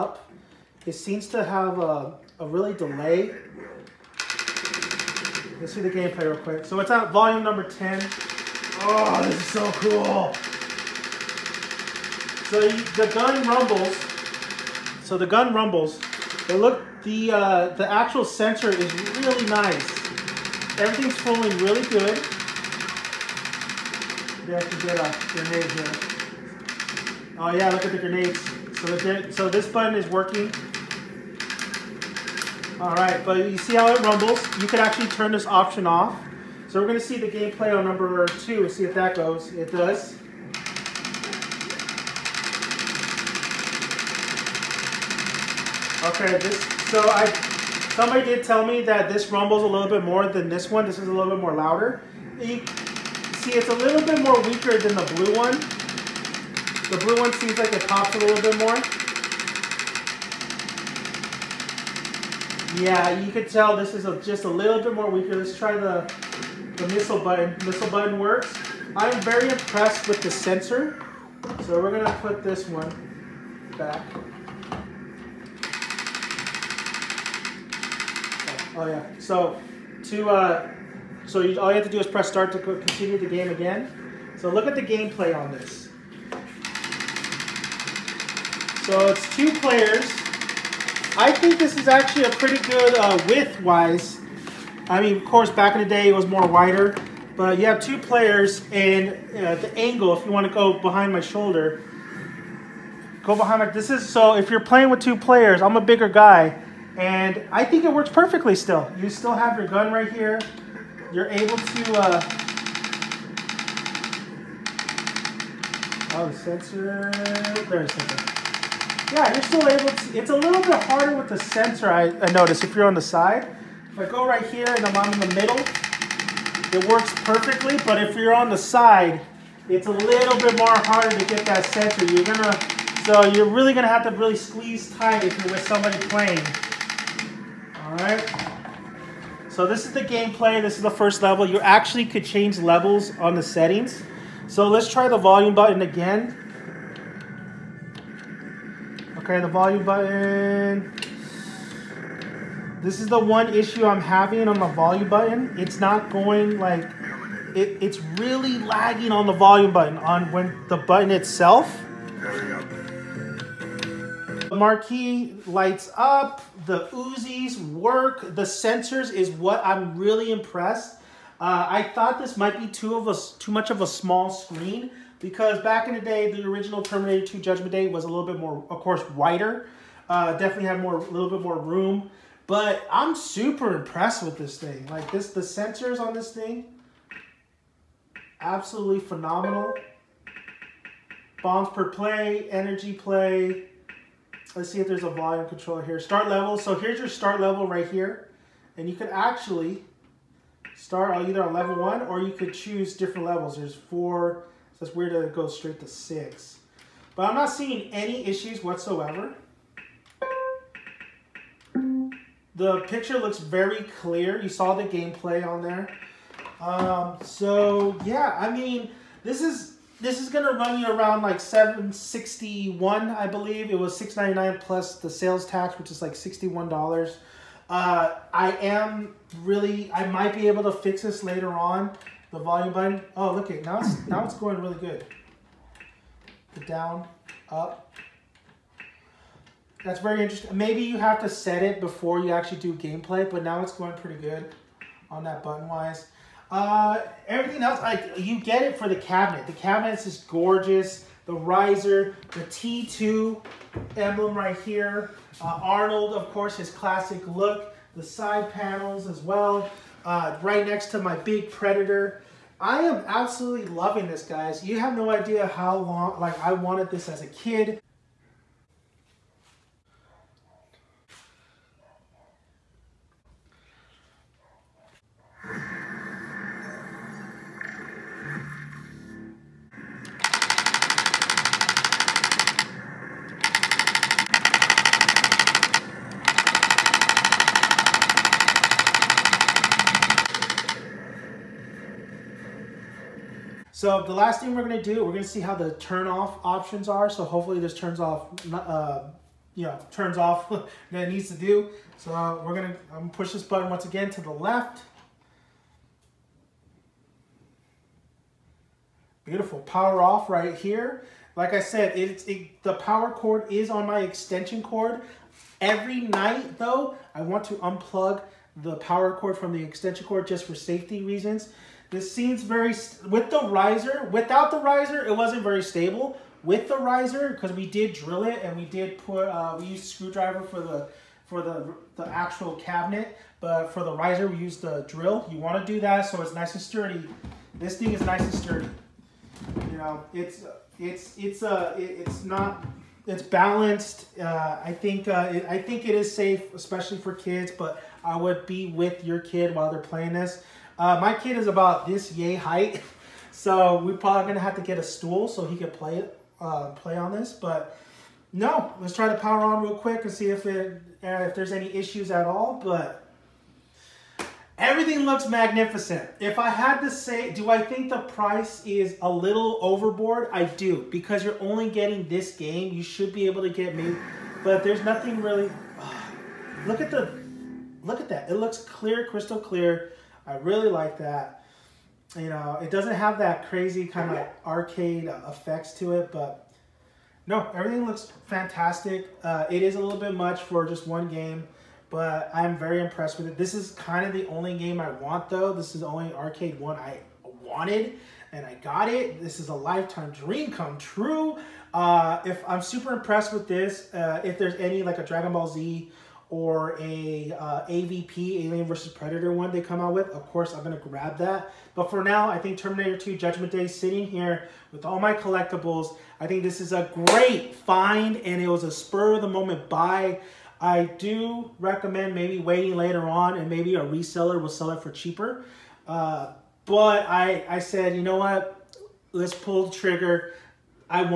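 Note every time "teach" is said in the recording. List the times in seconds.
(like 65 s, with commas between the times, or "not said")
not said.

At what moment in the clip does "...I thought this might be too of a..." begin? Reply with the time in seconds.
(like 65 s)
171 s.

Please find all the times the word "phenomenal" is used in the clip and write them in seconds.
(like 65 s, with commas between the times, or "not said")
189 s.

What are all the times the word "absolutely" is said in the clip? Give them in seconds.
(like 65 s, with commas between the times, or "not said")
188 s, 263 s.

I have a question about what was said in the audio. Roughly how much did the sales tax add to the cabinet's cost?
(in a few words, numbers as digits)
$61.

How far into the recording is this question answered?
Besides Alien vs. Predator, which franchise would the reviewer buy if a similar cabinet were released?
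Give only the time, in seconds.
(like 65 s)
405 s.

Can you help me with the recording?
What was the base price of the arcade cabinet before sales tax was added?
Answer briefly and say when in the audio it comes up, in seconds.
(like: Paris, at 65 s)
$699, at 223 s.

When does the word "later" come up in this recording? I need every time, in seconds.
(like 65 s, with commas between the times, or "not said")
231 s, 422 s.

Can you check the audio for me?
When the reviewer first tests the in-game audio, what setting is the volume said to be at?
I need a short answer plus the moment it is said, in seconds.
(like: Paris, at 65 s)
10, at 7 s.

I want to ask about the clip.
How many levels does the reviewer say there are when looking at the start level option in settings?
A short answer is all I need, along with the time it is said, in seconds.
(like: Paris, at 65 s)
4, at 203 s.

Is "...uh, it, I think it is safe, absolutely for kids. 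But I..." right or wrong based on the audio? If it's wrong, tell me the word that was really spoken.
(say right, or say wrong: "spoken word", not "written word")
wrong: "especially", not "absolutely".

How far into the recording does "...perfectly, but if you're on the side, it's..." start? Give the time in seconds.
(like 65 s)
127 s.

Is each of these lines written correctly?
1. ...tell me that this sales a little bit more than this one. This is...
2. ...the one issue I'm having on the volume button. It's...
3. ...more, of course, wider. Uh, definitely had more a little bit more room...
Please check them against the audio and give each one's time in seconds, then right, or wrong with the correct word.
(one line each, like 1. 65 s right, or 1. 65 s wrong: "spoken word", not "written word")
1. 48 s wrong: "rumbles", not "sales"
2. 153 s right
3. 178 s right.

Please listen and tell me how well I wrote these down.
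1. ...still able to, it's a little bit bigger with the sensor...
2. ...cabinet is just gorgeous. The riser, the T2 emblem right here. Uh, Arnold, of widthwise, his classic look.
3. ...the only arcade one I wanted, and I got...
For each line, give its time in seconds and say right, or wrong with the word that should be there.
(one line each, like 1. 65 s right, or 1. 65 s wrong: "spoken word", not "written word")
1. 119 s wrong: "harder", not "bigger"
2. 249 s wrong: "course", not "widthwise"
3. 395 s right.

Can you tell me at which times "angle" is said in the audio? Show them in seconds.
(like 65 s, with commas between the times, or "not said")
99 s.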